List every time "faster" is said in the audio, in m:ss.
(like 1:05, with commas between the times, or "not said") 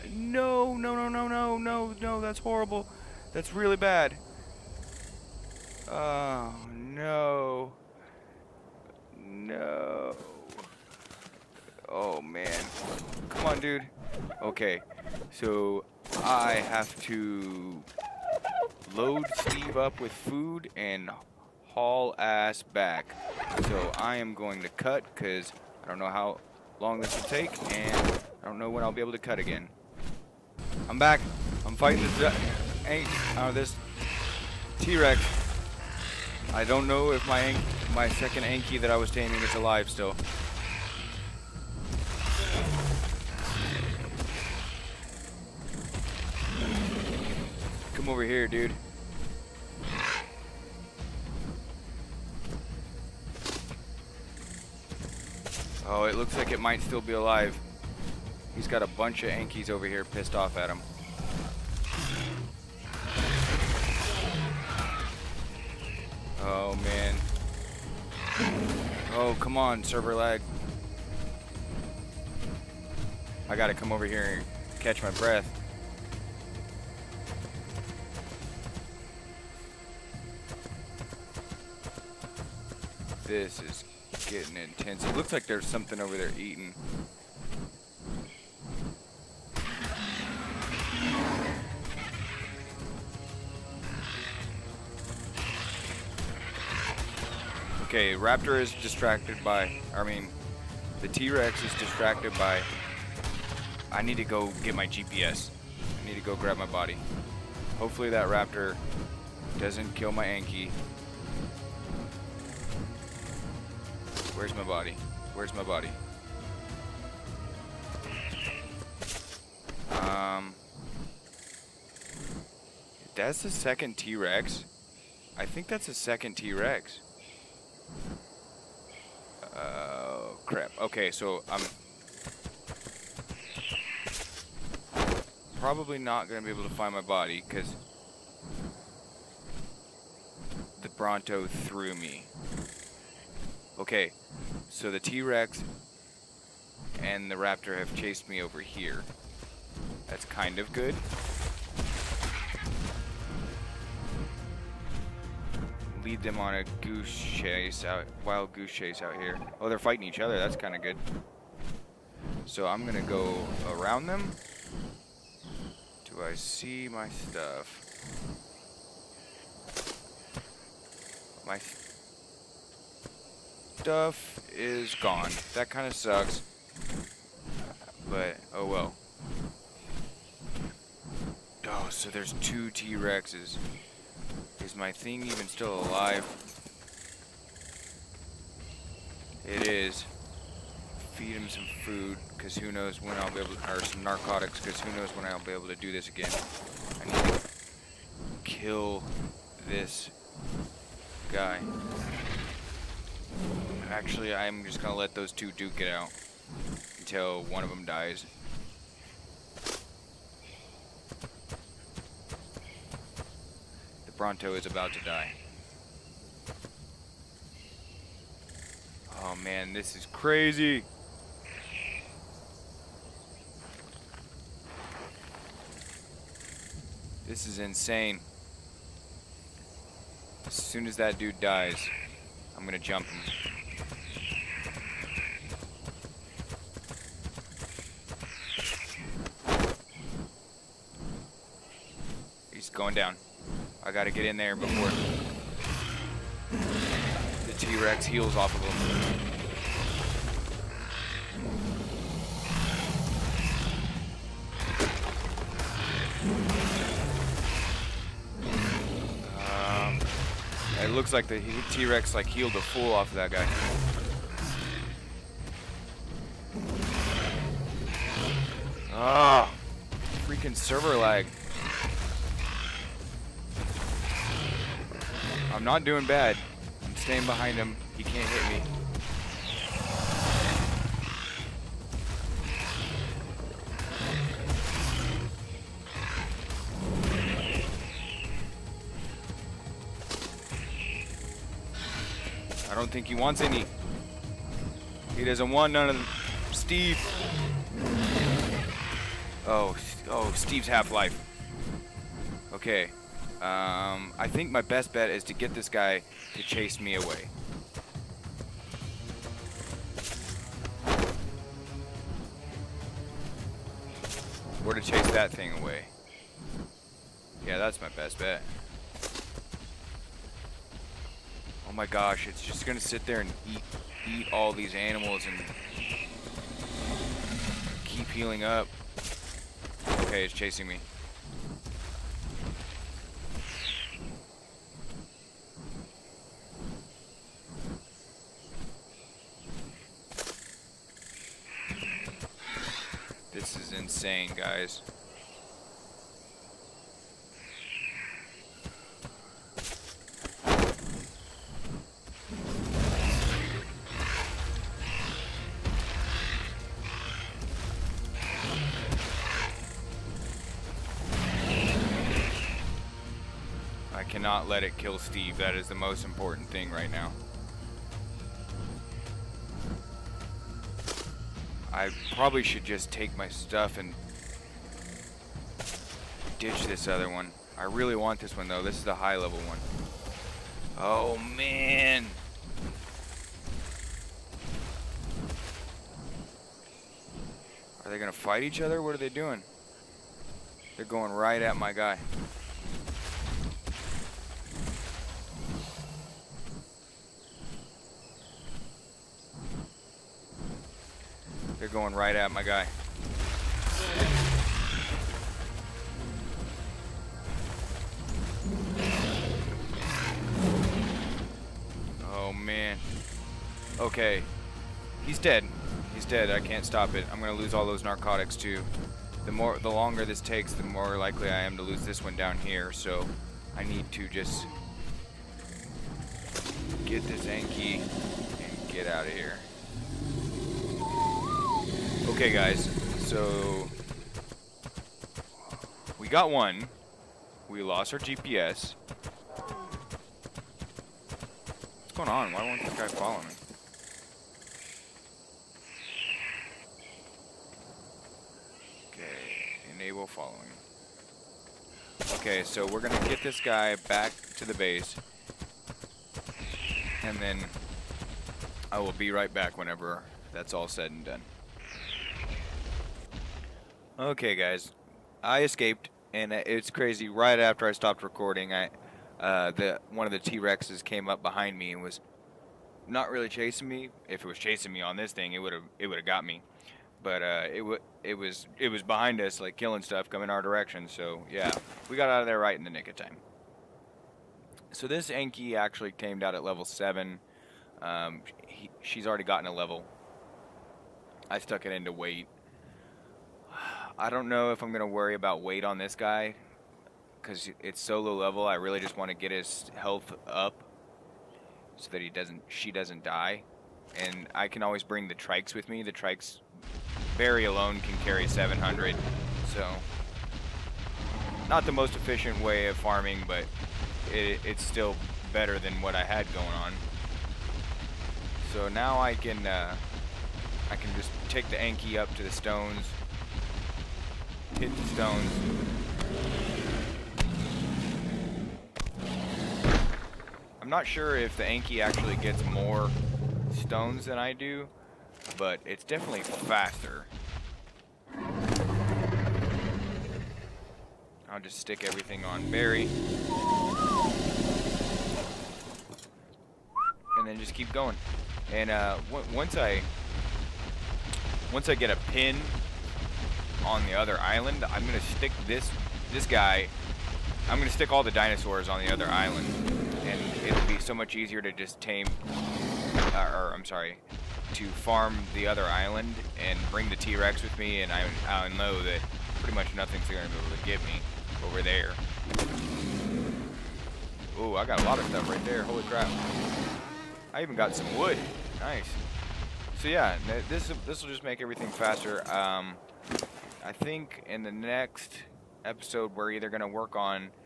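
8:56, 9:41.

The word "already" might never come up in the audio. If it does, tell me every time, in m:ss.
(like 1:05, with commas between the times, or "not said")
8:09.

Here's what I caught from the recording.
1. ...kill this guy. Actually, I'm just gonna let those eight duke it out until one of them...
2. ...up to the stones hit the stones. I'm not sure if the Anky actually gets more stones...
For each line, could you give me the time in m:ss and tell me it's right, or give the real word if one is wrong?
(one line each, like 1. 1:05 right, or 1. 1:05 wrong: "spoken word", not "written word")
1. 3:18 wrong: "two", not "eight"
2. 8:41 right.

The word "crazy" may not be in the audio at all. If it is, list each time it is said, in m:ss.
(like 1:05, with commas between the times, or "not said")
3:40, 7:46.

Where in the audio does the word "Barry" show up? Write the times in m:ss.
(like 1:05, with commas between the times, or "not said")
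8:27, 9:02.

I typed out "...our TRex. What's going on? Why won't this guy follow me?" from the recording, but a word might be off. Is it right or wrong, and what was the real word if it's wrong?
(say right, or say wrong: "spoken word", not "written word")
wrong: "GPS", not "TRex".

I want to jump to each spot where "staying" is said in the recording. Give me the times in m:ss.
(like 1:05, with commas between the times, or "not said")
4:36.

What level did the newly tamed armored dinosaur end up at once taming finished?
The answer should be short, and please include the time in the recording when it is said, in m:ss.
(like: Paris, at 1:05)
7, at 8:06.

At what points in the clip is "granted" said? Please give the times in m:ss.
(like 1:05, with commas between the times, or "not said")
not said.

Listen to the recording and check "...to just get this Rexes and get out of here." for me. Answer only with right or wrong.
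wrong.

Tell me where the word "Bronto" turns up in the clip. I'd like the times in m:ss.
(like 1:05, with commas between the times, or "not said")
2:20, 3:34.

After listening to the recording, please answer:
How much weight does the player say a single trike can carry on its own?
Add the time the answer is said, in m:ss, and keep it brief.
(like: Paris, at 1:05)
700, at 8:28.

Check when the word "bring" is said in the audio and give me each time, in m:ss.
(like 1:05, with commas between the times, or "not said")
8:24, 9:26.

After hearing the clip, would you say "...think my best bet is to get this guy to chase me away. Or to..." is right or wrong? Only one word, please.
right.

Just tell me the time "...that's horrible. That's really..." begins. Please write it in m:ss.
0:02.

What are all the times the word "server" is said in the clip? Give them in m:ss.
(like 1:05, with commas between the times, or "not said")
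1:09, 4:30.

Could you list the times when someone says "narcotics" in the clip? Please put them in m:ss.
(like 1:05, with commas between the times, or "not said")
3:14, 6:57.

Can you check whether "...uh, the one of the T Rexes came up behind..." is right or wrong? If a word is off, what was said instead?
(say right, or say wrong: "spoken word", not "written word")
right.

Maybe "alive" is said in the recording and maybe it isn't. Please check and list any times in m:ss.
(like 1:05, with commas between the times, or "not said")
0:39, 0:57, 3:05.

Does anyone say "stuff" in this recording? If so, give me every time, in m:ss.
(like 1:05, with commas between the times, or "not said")
2:47, 2:53, 6:13, 7:59, 9:35.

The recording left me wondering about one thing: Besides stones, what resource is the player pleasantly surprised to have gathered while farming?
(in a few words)
wood.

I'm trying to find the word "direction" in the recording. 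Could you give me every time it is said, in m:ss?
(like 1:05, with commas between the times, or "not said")
8:00.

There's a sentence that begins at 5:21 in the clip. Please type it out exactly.
Oh my gosh, it's just gonna sit there and eat, eat all these animals and keep healing up.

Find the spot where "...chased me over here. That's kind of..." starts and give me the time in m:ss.
2:27.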